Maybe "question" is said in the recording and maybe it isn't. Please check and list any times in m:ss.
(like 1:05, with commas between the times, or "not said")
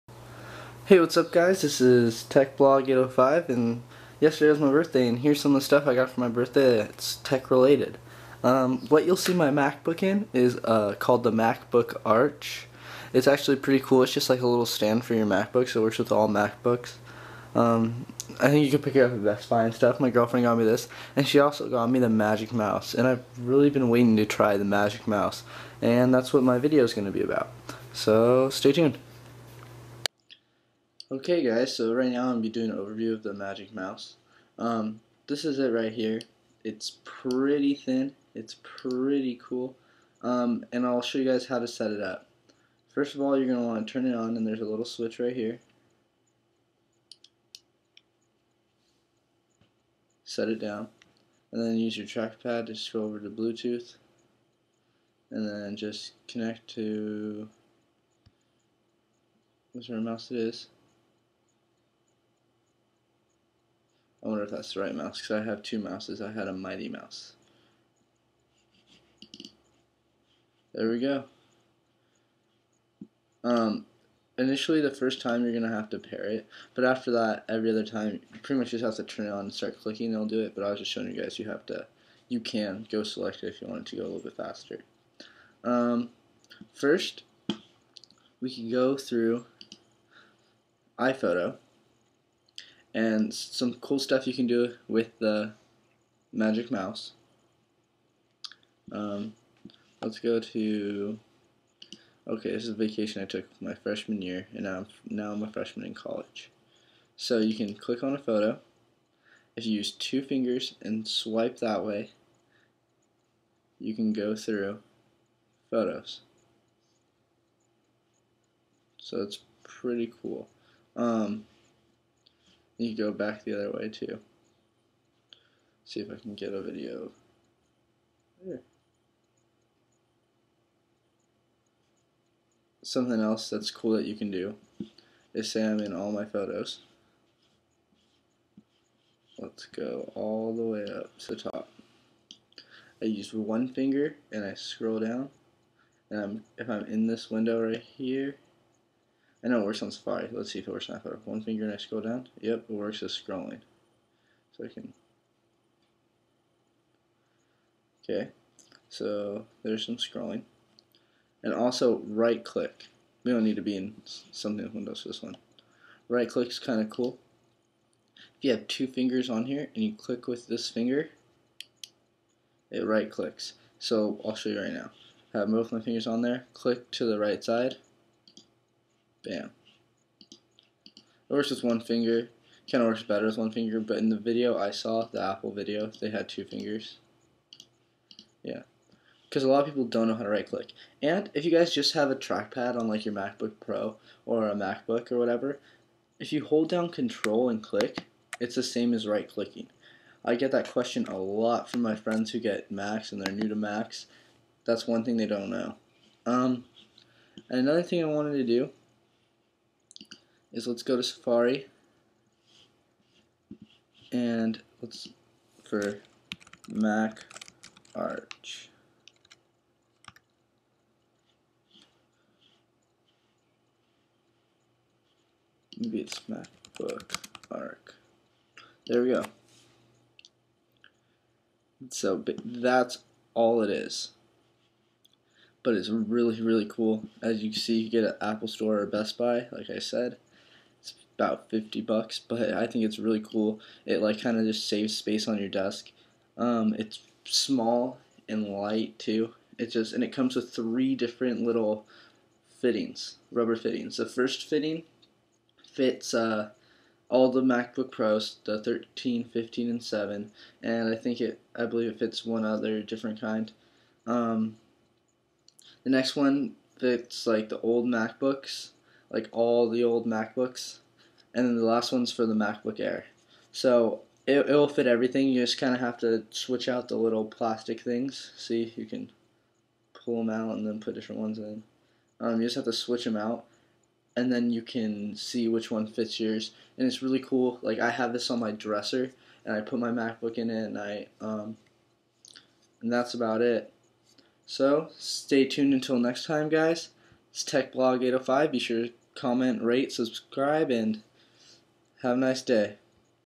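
3:20.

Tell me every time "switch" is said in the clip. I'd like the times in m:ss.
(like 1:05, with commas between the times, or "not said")
0:44, 4:36, 4:42.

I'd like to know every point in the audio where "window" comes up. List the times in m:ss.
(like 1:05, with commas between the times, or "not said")
2:27, 2:44.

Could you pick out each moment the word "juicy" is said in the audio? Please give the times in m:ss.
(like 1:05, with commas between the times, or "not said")
not said.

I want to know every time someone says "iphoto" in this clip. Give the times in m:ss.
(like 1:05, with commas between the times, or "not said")
1:30, 2:30.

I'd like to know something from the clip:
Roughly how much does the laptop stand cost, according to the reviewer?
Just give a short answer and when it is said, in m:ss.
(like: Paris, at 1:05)
$50, at 4:01.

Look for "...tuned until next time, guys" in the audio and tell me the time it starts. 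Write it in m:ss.
4:55.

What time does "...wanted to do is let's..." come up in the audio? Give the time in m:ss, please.
3:28.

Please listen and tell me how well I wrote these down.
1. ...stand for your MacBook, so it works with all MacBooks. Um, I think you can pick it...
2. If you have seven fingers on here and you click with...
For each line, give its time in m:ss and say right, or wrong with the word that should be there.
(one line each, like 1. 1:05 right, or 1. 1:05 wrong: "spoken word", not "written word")
1. 0:14 right
2. 2:48 wrong: "two", not "seven".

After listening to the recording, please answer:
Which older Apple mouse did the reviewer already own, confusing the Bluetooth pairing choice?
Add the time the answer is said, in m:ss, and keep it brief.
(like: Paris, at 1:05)
Mighty Mouse, at 1:06.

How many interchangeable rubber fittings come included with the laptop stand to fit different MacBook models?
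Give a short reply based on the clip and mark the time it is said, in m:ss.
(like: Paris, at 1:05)
3, at 4:10.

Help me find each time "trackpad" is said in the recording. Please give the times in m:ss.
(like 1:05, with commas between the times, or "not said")
0:52, 3:12.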